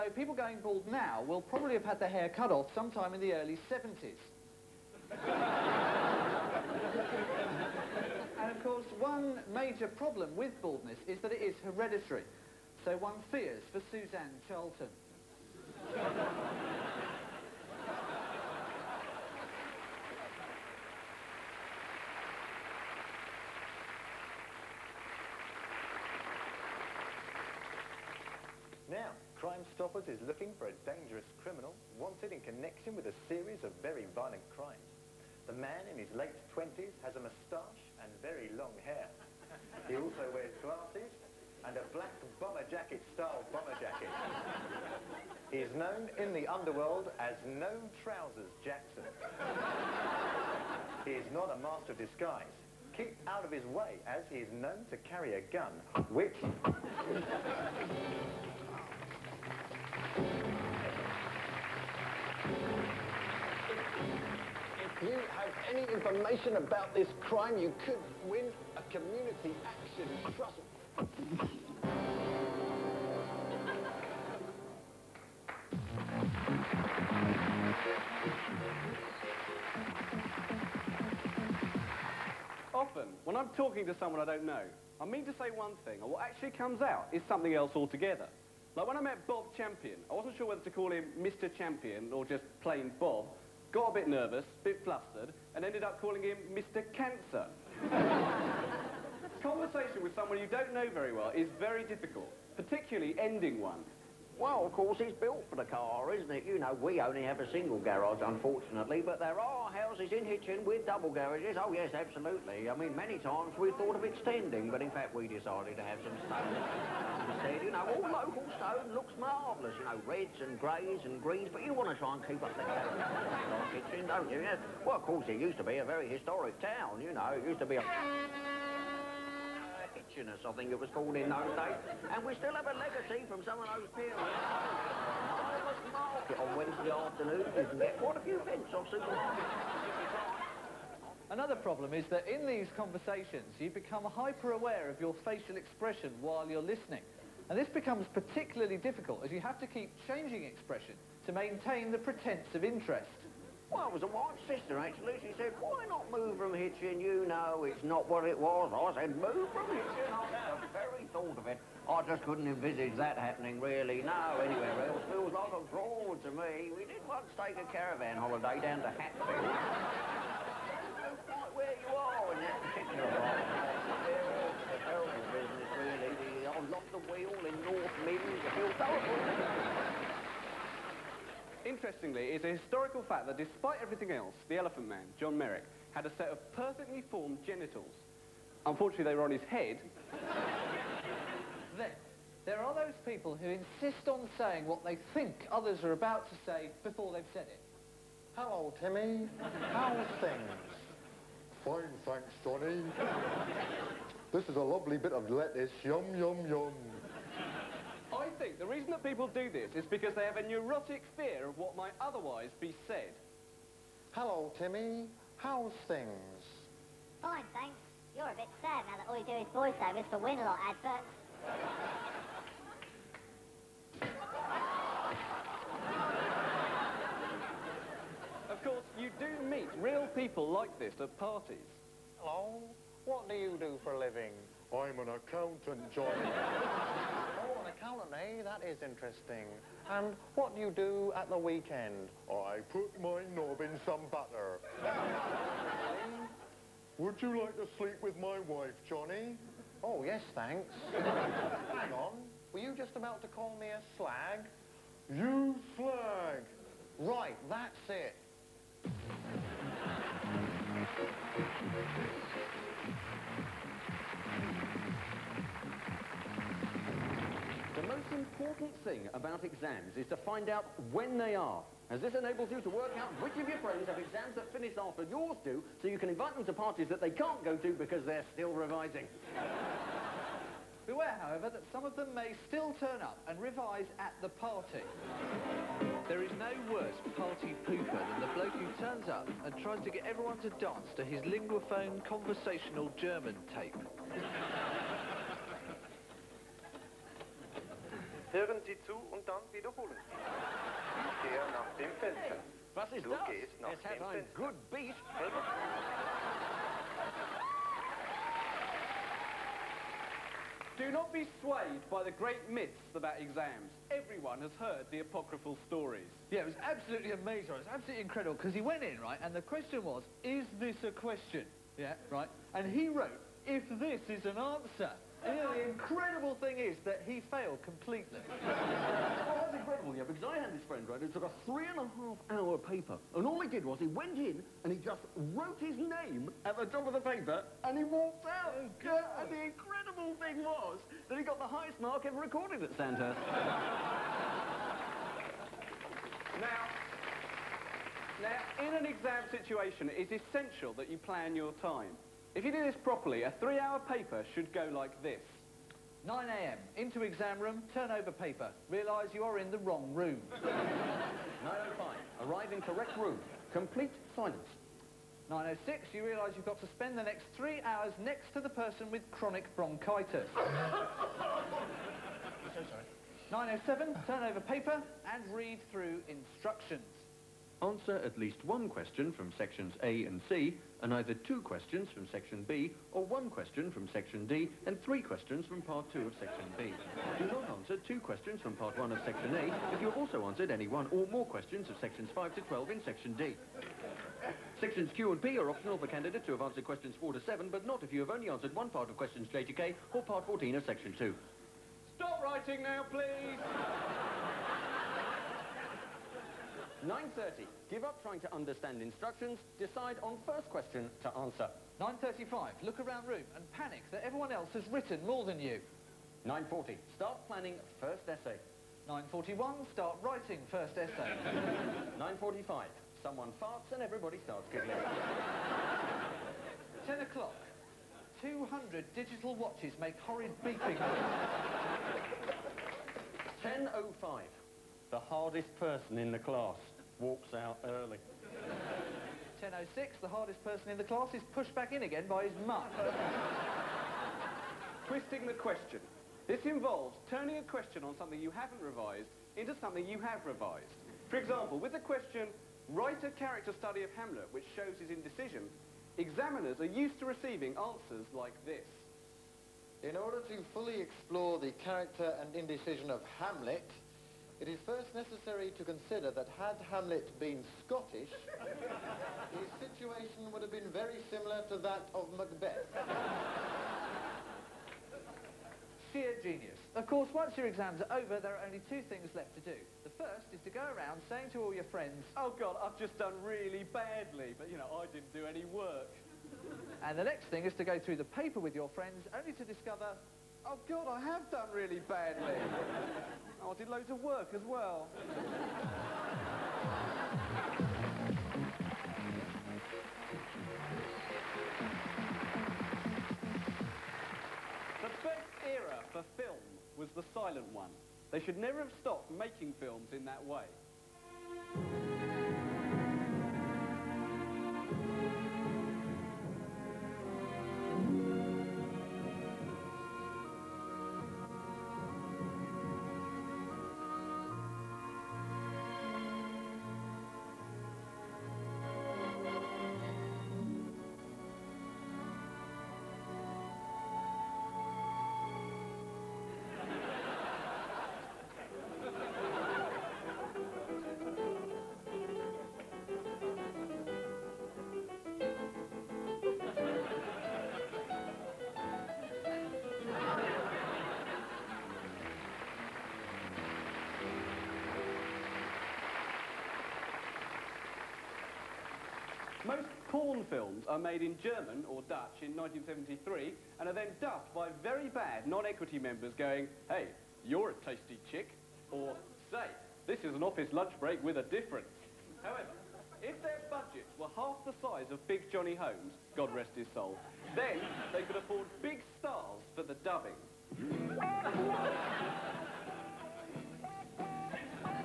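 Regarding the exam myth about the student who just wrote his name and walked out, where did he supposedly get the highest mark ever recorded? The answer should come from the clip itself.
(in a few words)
Sandhurst.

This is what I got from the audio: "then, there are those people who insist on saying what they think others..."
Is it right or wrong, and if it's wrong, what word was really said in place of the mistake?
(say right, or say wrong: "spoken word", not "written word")
right.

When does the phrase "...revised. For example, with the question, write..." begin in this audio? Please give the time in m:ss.
7:30.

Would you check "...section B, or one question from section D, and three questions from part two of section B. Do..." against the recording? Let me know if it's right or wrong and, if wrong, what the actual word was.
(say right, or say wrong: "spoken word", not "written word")
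right.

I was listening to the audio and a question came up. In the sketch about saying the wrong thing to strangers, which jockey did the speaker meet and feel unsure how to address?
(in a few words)
Bob Champion.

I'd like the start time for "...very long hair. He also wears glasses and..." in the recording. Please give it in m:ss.
0:38.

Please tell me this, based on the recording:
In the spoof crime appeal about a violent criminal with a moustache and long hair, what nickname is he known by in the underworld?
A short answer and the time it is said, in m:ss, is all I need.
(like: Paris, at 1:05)
No Trousers Jackson, at 0:47.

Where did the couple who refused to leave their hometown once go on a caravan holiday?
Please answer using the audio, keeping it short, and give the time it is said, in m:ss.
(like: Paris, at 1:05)
Hatfield, at 2:48.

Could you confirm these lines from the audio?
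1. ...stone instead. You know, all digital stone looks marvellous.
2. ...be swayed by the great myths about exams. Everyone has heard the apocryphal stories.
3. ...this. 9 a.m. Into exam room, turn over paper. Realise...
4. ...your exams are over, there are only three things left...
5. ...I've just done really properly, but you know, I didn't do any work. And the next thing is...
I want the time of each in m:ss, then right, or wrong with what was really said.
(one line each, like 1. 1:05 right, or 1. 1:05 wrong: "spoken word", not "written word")
1. 1:56 wrong: "local", not "digital"
2. 5:11 right
3. 5:55 right
4. 7:57 wrong: "two", not "three"
5. 8:02 wrong: "badly", not "properly".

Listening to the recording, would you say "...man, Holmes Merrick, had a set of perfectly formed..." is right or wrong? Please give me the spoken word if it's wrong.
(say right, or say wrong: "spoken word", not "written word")
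wrong: "John", not "Holmes".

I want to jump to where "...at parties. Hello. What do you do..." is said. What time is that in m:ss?
3:51.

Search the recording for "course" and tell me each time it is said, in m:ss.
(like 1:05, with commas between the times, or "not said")
0:08, 1:44, 2:05, 3:48, 7:56.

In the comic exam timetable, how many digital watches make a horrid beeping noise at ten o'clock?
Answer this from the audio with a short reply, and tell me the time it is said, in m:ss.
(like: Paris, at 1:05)
200, at 7:08.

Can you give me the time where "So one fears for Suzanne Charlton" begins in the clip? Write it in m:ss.
0:12.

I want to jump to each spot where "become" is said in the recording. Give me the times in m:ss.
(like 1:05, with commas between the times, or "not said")
2:23, 2:27.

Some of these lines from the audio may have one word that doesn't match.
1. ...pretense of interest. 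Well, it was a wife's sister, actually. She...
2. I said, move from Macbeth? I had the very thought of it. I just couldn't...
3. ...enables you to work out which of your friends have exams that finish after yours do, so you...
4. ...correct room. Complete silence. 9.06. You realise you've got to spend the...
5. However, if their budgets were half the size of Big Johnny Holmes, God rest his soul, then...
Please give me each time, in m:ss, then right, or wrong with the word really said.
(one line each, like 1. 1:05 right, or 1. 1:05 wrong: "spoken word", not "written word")
1. 2:31 right
2. 2:38 wrong: "Hitchin", not "Macbeth"
3. 4:32 right
4. 6:02 right
5. 9:32 right.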